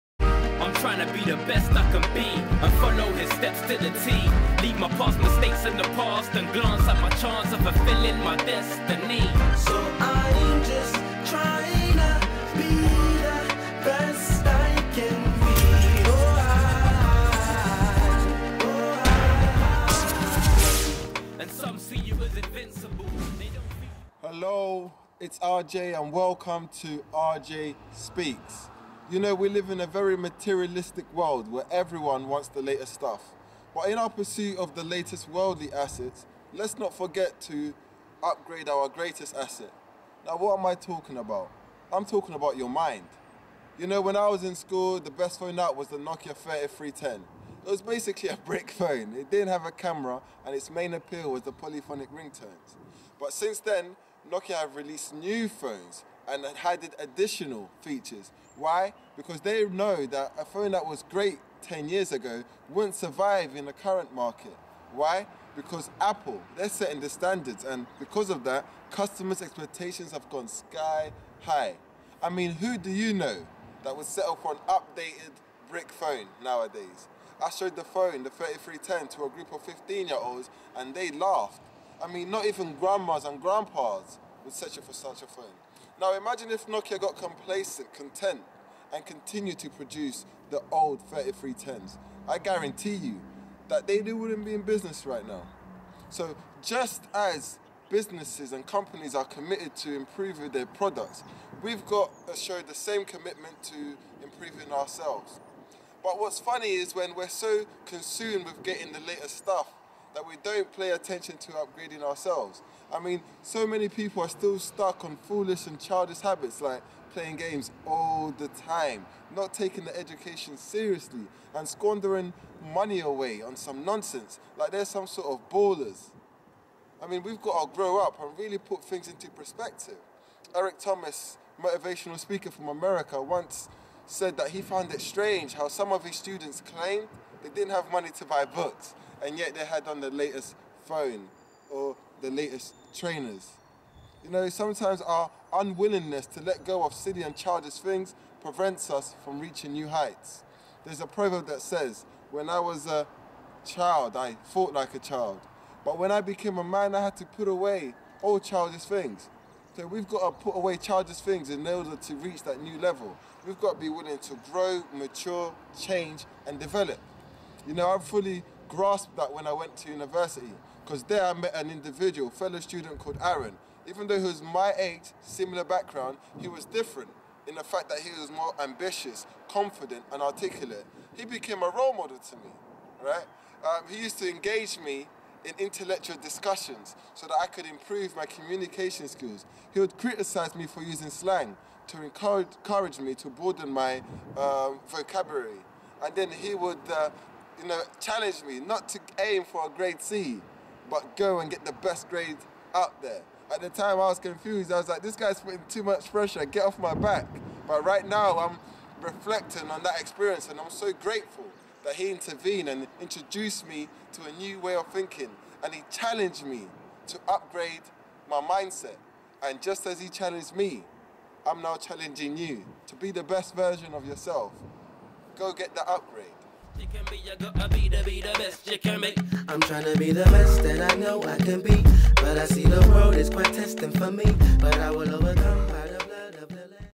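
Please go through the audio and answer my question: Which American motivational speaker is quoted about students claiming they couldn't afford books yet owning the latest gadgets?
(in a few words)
Eric Thomas.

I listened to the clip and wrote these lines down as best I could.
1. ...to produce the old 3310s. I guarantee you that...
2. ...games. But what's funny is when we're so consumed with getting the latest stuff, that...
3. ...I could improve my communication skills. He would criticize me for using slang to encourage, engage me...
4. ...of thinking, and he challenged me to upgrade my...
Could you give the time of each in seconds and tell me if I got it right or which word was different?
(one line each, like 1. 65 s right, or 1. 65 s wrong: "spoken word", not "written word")
1. 89 s right
2. 104 s wrong: "ourselves", not "games"
3. 187 s wrong: "encourage", not "engage"
4. 214 s right.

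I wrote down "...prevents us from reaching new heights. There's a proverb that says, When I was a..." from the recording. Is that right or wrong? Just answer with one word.
right.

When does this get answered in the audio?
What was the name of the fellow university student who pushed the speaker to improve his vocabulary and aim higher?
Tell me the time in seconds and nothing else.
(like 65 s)
173 s.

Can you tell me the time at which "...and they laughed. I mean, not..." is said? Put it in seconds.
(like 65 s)
80 s.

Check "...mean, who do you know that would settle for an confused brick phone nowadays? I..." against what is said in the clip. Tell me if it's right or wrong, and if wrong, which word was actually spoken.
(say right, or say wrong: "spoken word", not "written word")
wrong: "updated", not "confused".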